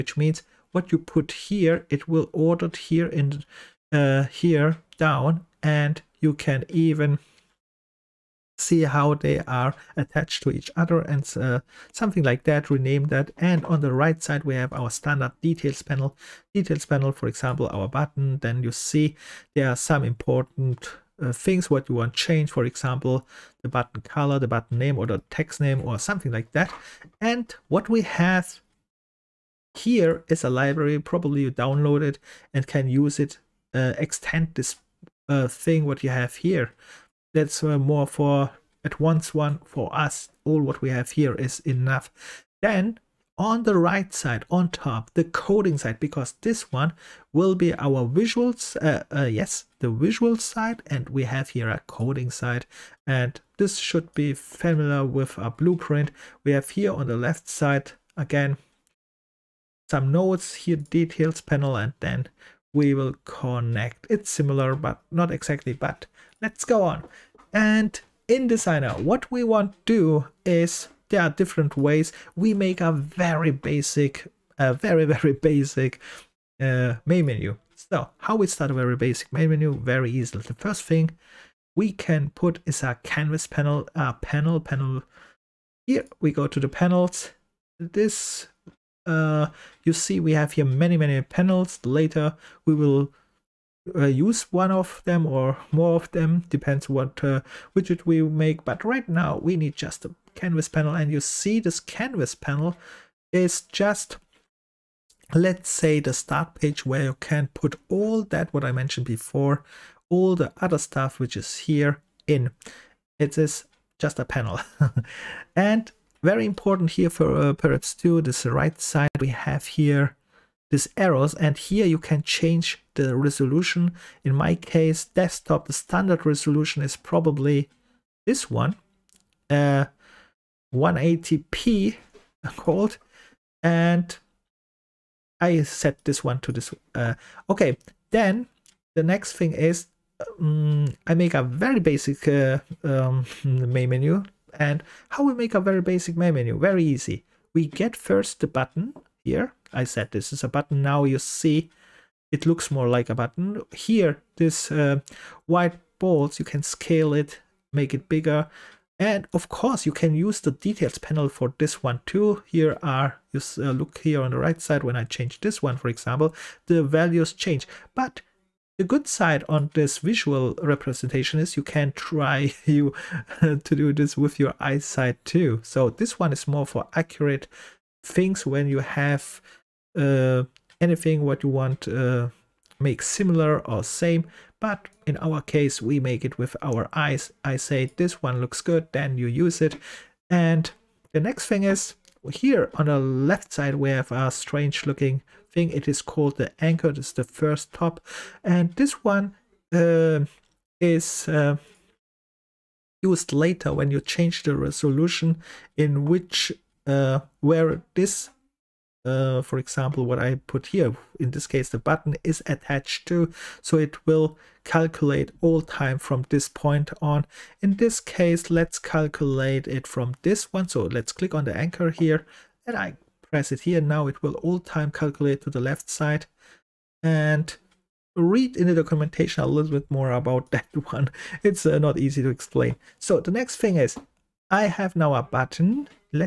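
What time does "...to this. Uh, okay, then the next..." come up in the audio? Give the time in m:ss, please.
2:16.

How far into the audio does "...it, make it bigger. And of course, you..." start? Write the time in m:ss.
2:37.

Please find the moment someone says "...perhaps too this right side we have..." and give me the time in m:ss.
1:57.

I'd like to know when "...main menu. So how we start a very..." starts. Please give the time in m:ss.
1:17.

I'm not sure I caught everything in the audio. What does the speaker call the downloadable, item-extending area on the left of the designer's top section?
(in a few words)
A library.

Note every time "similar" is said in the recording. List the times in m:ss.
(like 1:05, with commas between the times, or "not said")
1:04, 3:03.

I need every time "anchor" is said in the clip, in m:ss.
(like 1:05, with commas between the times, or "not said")
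3:16, 3:41.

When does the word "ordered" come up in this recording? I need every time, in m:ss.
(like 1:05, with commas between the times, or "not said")
0:02.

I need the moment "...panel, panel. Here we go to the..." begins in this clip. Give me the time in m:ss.
1:24.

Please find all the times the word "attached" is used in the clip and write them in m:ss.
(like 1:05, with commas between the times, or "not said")
0:09, 3:32.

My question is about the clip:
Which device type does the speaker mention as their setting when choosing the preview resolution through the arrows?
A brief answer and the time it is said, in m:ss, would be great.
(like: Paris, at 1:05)
Desktop, at 2:05.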